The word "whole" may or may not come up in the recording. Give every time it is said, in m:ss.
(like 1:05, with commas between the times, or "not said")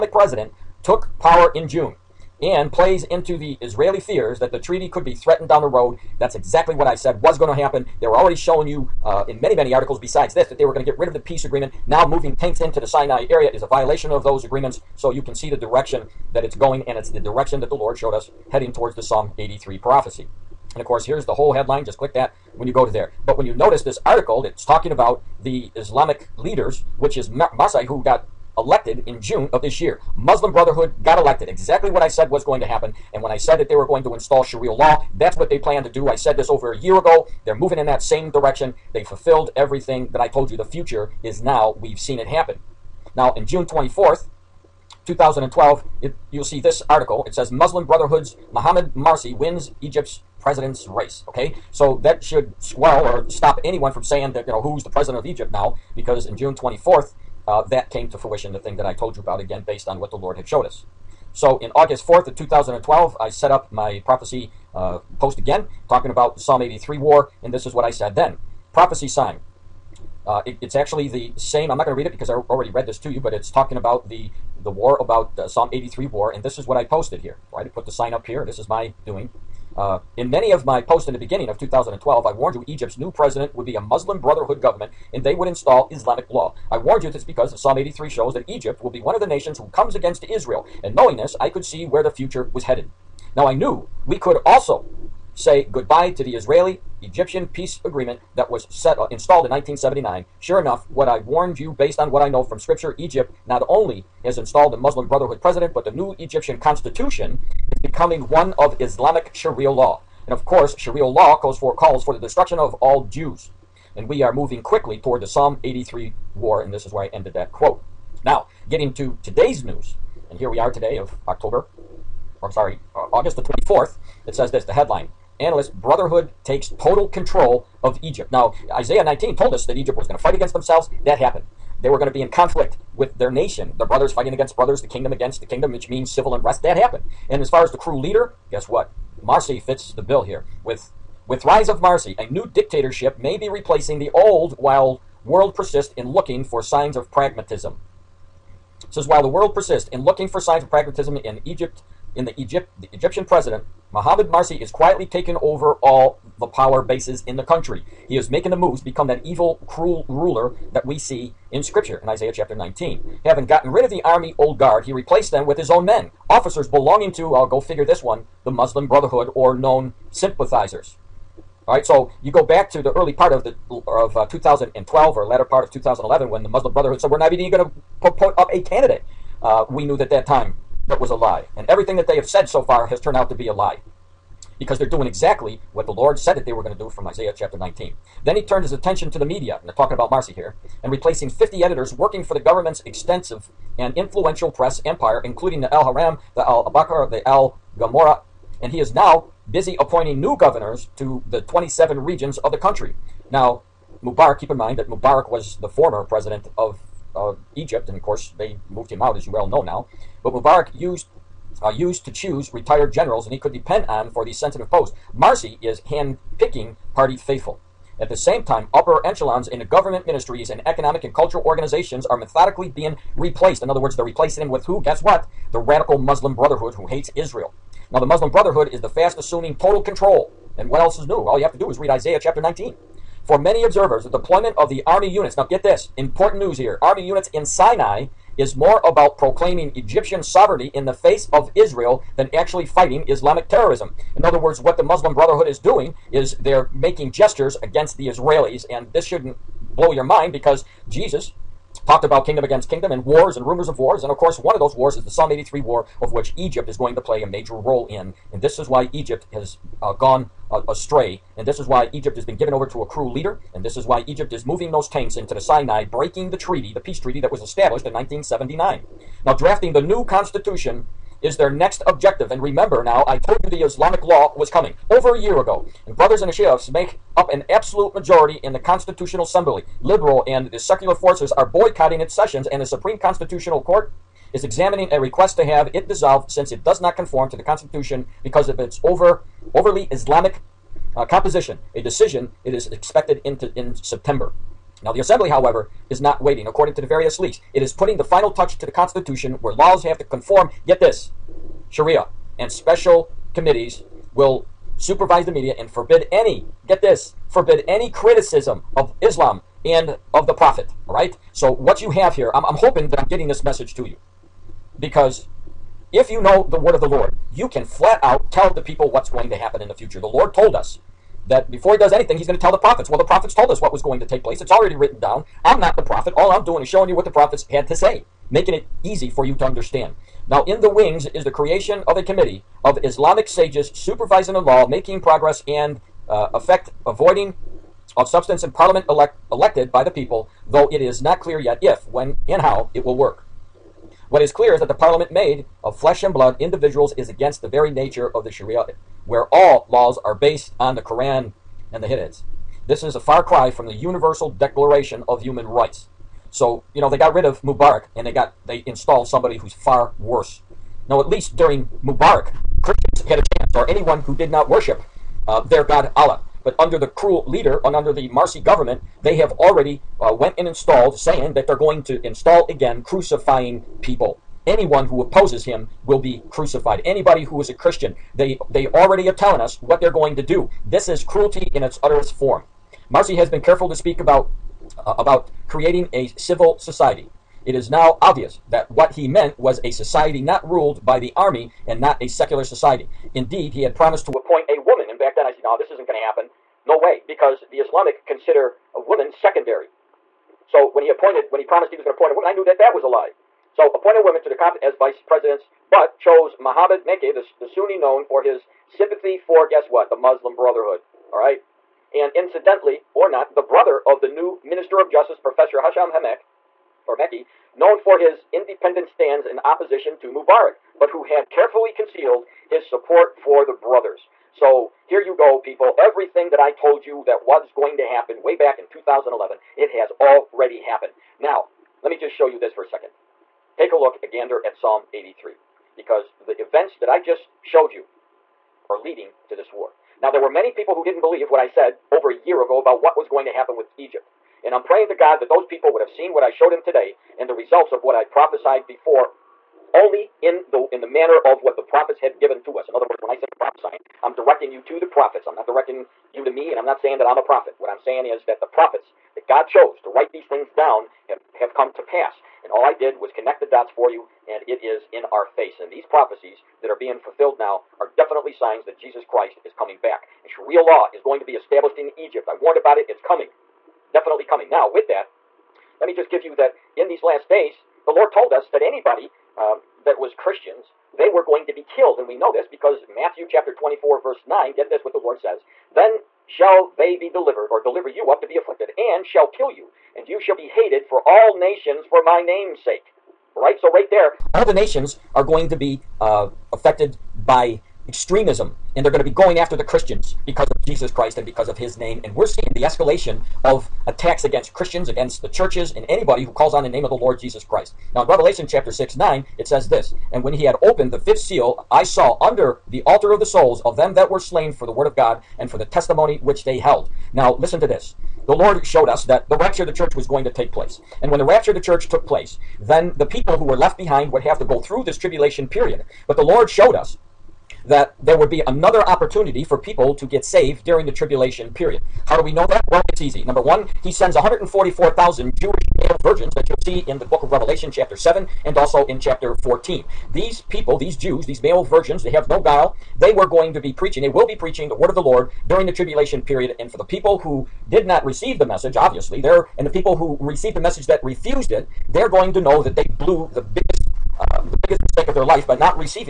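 0:21.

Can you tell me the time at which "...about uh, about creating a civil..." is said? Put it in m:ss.
6:23.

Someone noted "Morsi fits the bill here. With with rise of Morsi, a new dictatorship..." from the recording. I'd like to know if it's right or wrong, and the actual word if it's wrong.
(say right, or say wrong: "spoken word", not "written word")
right.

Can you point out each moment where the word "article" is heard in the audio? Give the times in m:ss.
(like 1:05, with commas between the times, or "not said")
0:09, 0:24, 0:46.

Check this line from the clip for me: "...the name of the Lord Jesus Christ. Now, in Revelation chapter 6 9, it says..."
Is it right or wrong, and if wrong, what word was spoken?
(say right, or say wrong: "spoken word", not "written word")
right.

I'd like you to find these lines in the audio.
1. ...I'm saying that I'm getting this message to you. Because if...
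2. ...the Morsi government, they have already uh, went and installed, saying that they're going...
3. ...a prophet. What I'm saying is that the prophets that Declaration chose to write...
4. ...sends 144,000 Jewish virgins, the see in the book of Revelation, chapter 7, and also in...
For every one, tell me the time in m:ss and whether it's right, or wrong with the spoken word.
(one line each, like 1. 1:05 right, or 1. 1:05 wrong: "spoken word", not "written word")
1. 5:12 wrong: "hoping", not "saying"
2. 6:07 right
3. 7:37 wrong: "God", not "Declaration"
4. 8:53 right.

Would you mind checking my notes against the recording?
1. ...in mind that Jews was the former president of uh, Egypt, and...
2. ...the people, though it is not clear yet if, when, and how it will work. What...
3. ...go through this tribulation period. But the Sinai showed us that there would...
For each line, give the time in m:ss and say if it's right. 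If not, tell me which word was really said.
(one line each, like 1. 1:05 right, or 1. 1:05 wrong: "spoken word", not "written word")
1. 3:24 wrong: "Mubarak", not "Jews"
2. 5:39 right
3. 8:44 wrong: "Lord", not "Sinai".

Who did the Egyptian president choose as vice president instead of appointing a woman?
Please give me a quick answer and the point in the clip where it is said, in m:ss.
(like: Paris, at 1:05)
Mohammed Mekki, at 6:46.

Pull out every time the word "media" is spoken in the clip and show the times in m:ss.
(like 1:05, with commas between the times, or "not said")
3:09, 5:05.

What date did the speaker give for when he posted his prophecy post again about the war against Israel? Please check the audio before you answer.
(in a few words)
August 4th of 2012.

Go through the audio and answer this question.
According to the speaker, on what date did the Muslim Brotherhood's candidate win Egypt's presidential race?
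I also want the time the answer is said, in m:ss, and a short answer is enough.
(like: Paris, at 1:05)
June 24th, 2012, at 0:43.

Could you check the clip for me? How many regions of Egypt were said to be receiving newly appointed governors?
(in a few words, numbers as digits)
27.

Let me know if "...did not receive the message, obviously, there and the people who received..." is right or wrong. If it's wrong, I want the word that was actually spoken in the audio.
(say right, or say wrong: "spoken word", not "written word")
right.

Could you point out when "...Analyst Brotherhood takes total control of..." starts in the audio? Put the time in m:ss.
2:05.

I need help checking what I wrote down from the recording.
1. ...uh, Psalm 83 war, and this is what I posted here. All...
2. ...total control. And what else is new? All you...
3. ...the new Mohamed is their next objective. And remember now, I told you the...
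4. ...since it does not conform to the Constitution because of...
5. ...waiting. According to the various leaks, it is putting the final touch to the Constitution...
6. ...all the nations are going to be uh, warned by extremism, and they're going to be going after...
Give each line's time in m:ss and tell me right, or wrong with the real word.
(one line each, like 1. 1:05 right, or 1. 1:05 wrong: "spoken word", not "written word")
1. 1:15 right
2. 3:49 right
3. 4:29 wrong: "Constitution", not "Mohamed"
4. 4:46 right
5. 4:56 right
6. 8:14 wrong: "affected", not "warned".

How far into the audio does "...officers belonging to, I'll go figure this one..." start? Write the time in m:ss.
2:46.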